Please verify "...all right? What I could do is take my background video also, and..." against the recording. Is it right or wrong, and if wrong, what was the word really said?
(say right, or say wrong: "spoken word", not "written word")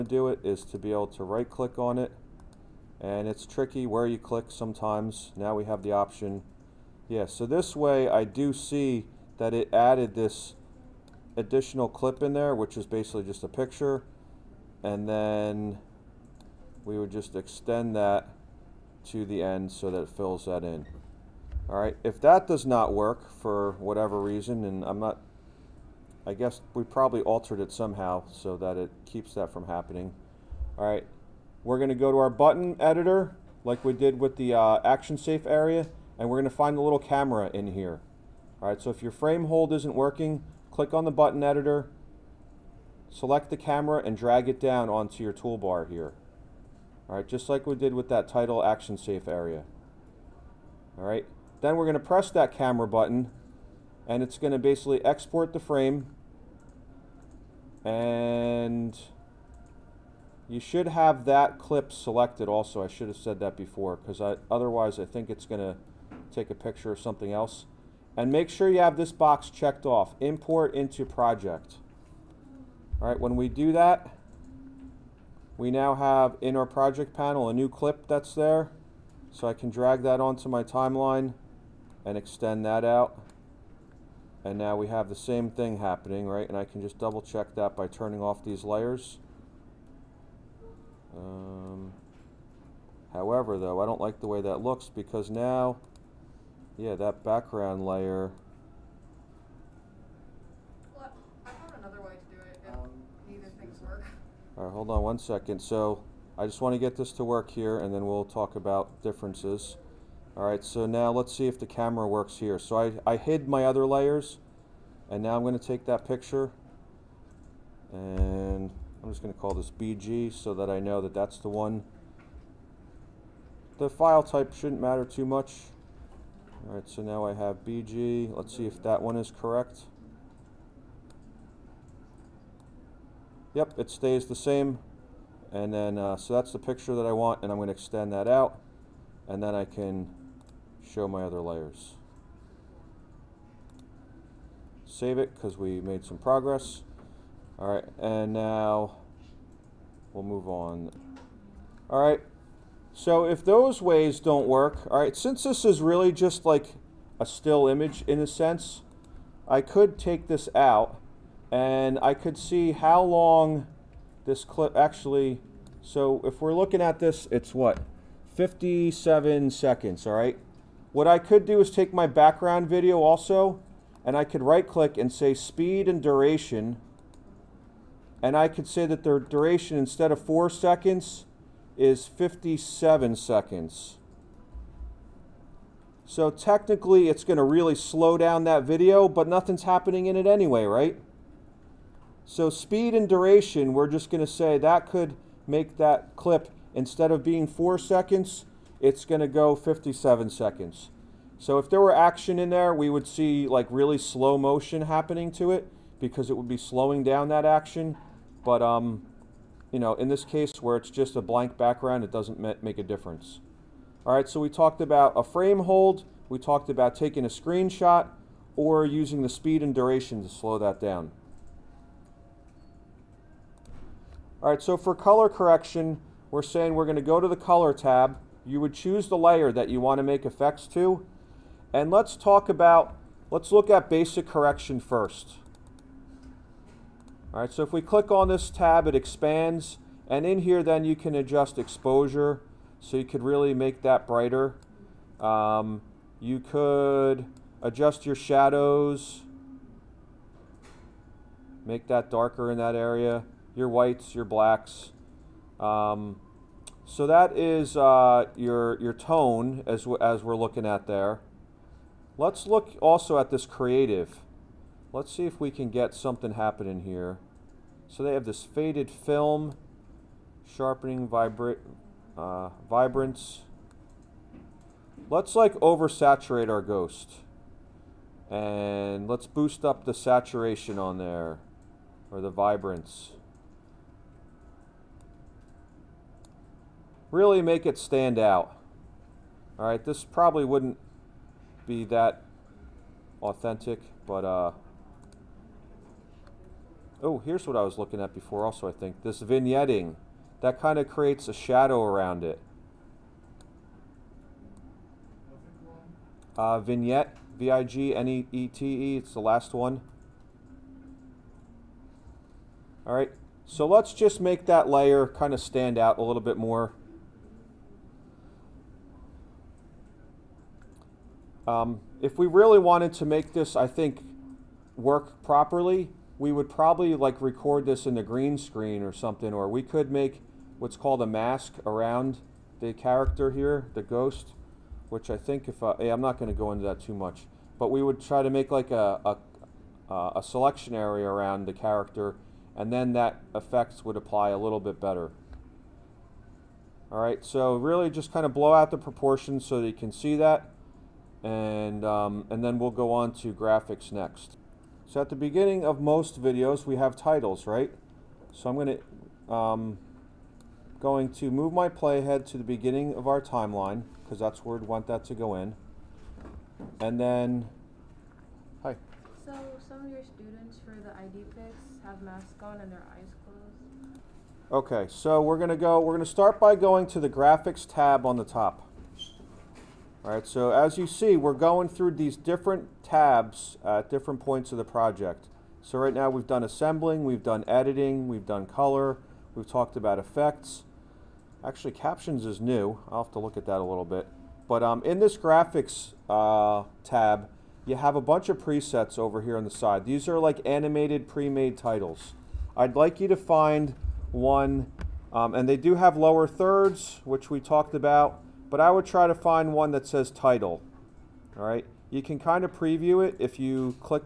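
right.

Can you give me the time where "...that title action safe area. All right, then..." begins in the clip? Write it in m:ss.
0:48.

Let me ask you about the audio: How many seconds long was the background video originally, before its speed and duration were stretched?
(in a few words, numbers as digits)
4.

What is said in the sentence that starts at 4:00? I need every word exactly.
And in here, then you can adjust exposure.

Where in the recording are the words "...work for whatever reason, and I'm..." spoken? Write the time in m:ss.
0:22.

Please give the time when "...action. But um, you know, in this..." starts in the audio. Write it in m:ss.
3:27.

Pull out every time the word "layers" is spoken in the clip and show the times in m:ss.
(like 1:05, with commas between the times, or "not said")
1:28, 1:37, 1:53, 2:21, 3:49, 5:14.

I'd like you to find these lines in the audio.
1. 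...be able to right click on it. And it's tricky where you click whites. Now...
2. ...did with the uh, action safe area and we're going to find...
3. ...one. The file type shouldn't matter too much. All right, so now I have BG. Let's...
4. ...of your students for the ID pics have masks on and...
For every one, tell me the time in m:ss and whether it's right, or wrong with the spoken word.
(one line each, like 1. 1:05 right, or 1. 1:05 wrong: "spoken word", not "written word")
1. 0:00 wrong: "sometimes", not "whites"
2. 0:33 right
3. 2:01 right
4. 6:09 right.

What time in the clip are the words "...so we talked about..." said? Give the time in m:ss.
3:34.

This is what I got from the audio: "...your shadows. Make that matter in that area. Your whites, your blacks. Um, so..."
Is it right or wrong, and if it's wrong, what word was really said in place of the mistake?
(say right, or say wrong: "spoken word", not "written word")
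wrong: "darker", not "matter".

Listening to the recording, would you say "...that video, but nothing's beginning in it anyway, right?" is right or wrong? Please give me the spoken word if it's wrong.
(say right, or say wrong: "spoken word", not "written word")
wrong: "happening", not "beginning".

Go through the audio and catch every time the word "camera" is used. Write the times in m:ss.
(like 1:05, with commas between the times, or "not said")
0:36, 0:43, 0:52, 1:51.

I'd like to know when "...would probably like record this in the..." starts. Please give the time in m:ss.
5:26.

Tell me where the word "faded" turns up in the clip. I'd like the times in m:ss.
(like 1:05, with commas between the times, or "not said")
4:28.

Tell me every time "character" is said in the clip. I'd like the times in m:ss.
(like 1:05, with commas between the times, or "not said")
5:32, 5:41.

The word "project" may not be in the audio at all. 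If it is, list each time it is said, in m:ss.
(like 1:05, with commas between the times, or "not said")
1:11, 1:16, 6:24.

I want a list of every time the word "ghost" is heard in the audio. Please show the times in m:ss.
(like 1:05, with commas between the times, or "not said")
4:36, 5:33.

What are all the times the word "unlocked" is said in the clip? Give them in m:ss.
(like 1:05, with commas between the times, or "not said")
not said.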